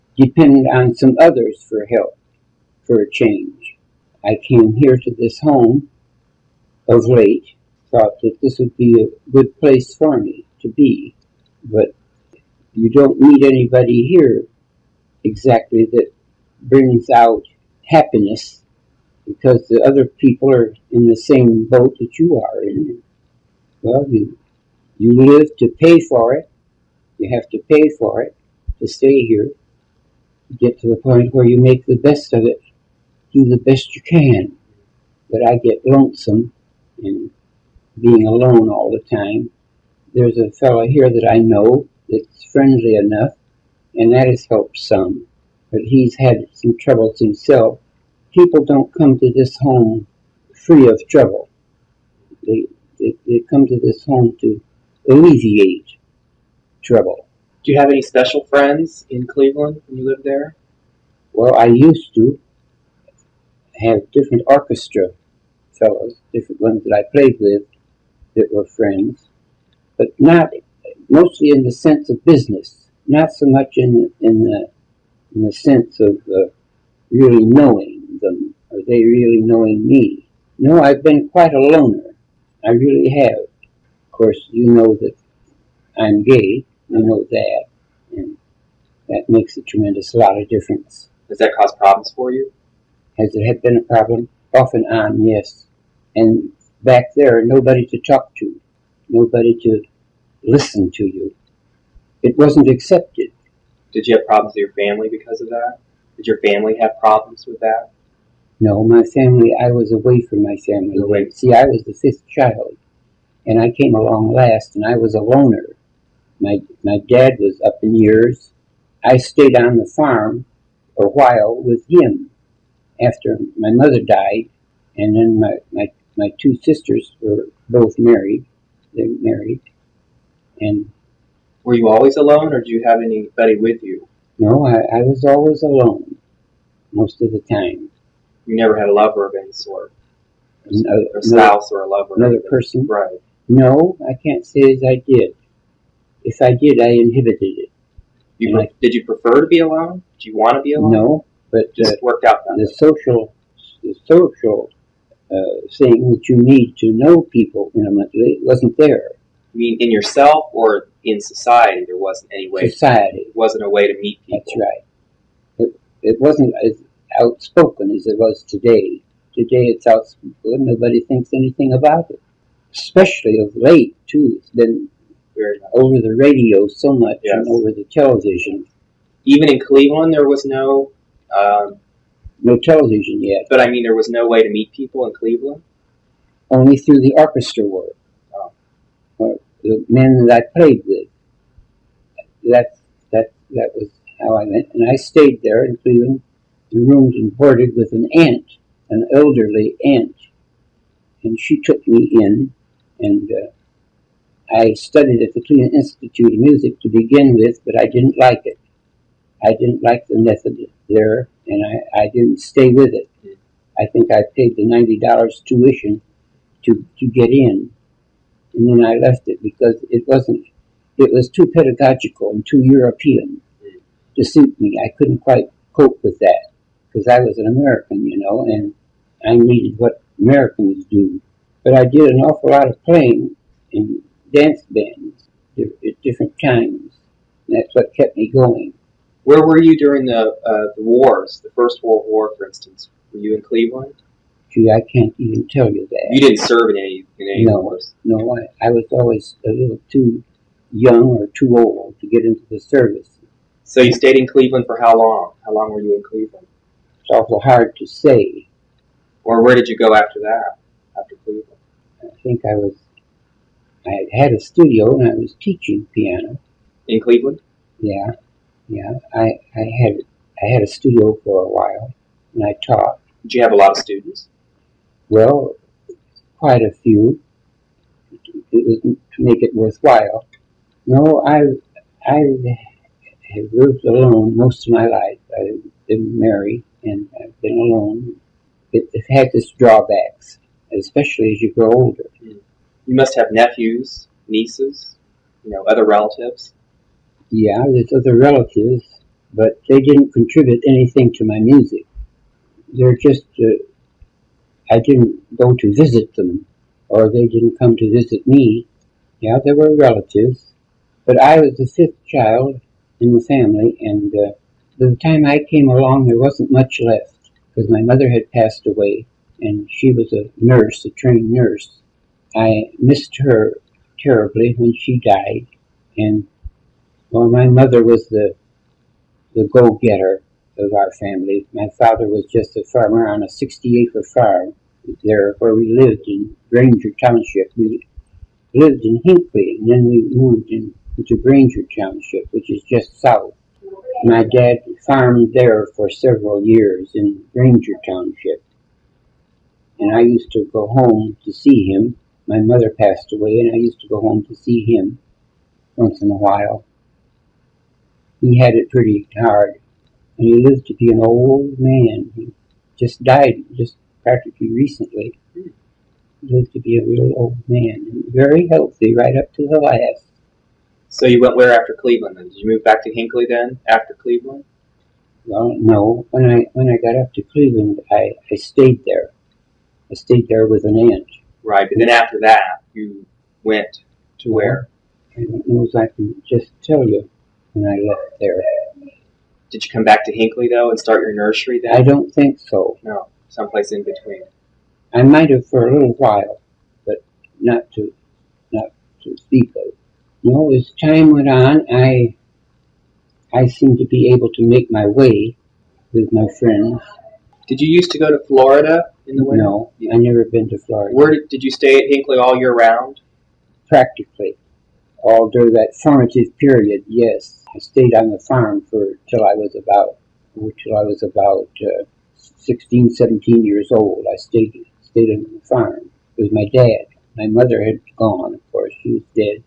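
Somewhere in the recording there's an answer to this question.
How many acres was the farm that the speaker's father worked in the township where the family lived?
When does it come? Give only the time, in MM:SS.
05:33.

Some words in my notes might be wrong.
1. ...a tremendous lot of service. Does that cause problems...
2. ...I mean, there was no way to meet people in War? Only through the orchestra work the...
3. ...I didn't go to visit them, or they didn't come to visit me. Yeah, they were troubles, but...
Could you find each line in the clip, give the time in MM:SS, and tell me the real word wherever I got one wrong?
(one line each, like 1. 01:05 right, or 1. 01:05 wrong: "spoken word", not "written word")
1. 01:29 wrong: "difference", not "service"
2. 03:03 wrong: "Cleveland", not "War"
3. 05:04 wrong: "relatives", not "troubles".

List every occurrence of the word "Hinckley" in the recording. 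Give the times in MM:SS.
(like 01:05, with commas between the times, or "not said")
05:39, 06:12, 06:30, 06:51.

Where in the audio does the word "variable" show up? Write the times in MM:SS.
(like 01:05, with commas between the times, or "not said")
not said.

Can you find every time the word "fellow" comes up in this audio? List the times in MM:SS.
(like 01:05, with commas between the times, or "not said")
00:40, 01:05.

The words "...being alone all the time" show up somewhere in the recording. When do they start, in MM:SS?
00:37.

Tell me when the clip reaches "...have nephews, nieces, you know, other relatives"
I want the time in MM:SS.
04:53.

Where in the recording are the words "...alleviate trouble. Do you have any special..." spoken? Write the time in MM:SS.
00:55.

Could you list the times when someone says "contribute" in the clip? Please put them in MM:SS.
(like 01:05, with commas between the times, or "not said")
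05:00.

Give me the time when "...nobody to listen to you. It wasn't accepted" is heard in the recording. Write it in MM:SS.
01:39.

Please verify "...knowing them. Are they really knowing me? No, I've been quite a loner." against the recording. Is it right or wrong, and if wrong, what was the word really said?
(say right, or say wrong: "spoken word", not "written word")
right.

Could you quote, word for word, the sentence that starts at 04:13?
So you stayed in Cleveland for how long?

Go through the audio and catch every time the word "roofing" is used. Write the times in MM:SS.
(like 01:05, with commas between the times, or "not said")
not said.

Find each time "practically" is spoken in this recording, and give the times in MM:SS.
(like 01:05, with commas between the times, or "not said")
06:04, 06:53.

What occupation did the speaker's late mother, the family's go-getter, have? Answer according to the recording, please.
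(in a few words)
trained nurse.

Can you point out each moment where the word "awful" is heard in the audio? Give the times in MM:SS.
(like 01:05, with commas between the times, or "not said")
03:52, 04:17.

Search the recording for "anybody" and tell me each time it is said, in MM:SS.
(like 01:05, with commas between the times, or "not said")
00:13, 02:13.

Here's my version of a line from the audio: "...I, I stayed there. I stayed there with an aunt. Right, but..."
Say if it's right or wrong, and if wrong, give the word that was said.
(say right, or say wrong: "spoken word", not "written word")
right.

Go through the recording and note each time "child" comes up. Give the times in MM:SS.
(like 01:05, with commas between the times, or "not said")
01:52, 05:12.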